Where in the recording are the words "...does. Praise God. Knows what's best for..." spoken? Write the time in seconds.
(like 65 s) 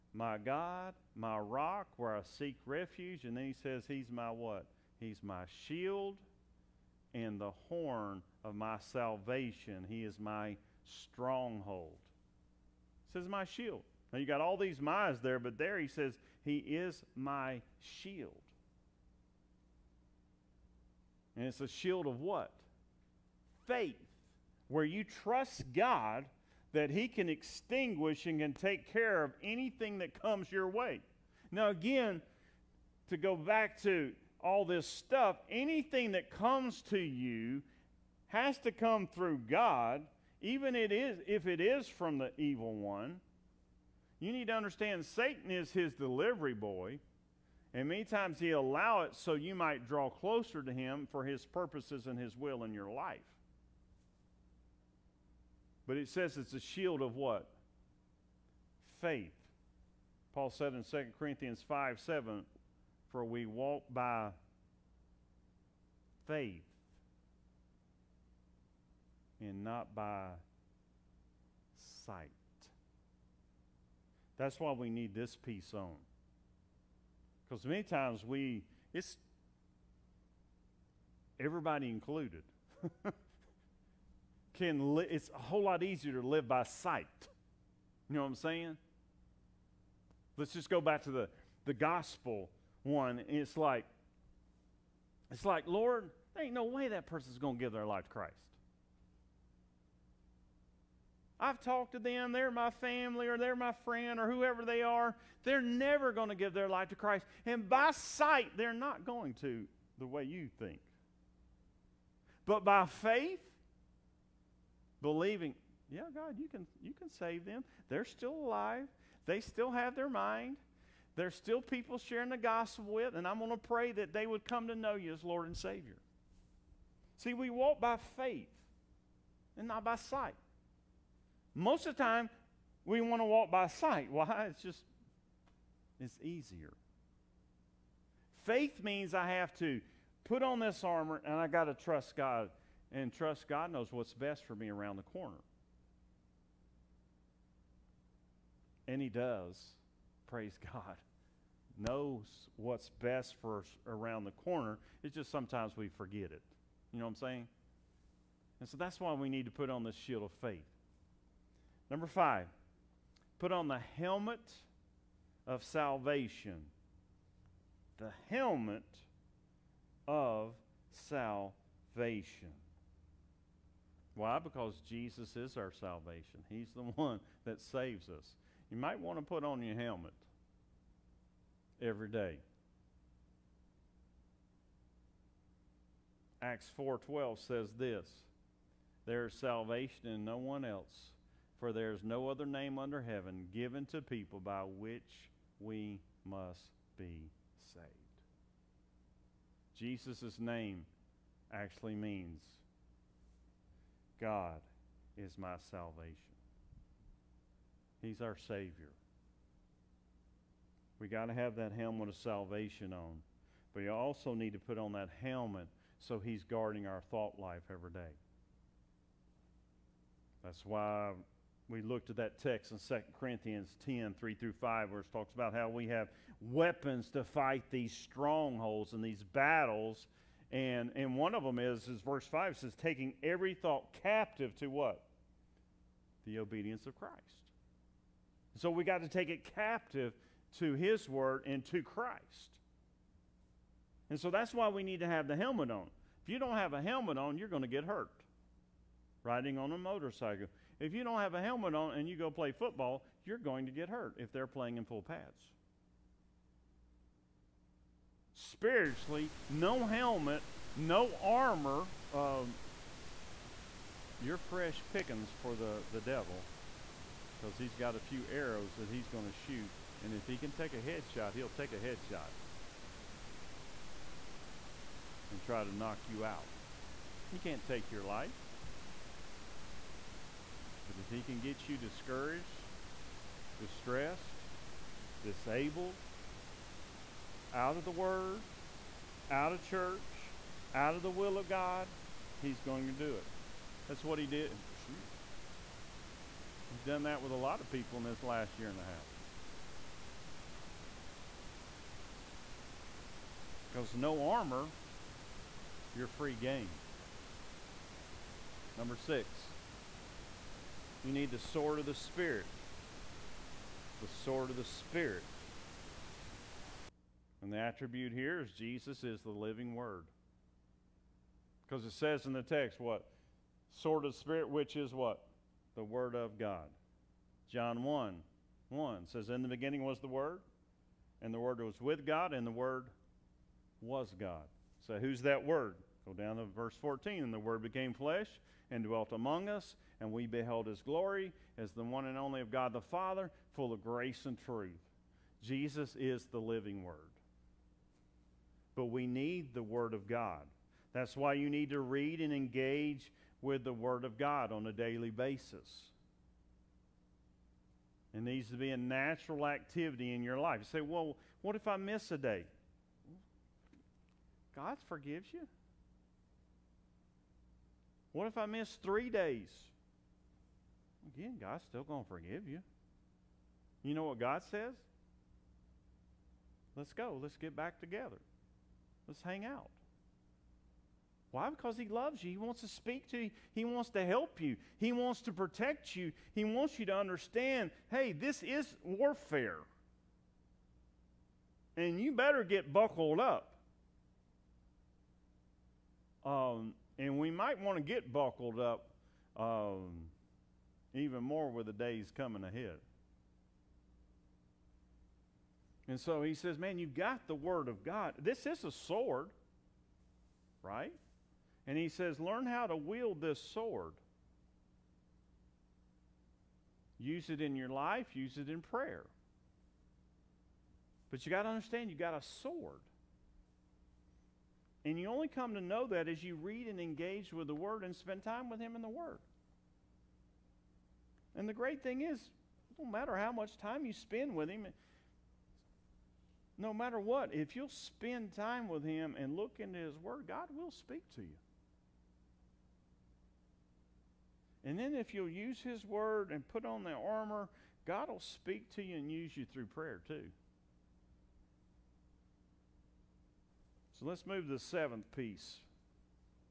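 149 s.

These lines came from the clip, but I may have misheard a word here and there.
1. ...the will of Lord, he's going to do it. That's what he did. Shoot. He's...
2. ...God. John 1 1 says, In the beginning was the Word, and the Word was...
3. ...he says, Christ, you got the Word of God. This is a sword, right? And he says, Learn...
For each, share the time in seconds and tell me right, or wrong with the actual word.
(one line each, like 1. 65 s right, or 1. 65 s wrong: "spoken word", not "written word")
1. 291 s wrong: "God", not "Lord"
2. 326 s right
3. 406 s wrong: "Man", not "Christ".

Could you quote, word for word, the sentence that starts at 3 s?
And then he says, He's my what?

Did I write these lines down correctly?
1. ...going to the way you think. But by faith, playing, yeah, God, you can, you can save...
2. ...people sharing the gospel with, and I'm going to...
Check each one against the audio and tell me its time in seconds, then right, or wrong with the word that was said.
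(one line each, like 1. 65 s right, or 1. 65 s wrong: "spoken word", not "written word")
1. 109 s wrong: "believing", not "playing"
2. 121 s right.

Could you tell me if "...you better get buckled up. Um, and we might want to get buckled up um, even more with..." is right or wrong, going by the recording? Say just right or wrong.
right.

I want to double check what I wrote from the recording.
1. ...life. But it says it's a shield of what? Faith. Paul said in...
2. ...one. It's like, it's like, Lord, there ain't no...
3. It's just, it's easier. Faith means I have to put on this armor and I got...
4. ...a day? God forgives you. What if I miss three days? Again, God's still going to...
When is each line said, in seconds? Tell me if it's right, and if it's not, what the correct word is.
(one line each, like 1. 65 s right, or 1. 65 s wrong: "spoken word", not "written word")
1. 52 s right
2. 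92 s right
3. 134 s right
4. 362 s right.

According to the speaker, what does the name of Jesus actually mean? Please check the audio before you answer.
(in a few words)
God is my salvation.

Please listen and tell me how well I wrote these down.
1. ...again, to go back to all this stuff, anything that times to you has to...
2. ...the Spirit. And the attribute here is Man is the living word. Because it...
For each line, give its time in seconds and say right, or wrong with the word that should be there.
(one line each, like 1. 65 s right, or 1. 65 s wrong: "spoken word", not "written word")
1. 31 s wrong: "comes", not "times"
2. 314 s wrong: "Jesus", not "Man".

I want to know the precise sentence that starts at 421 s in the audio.
But you got to understand, you got a sword.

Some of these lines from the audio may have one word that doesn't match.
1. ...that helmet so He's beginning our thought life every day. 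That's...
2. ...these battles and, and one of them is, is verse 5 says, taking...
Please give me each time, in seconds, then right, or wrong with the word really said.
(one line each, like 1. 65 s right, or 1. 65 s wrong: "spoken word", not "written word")
1. 214 s wrong: "guarding", not "beginning"
2. 229 s right.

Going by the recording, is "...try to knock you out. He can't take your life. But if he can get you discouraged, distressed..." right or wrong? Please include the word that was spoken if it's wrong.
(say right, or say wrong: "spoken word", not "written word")
right.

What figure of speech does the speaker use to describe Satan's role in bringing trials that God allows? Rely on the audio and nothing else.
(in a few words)
delivery boy.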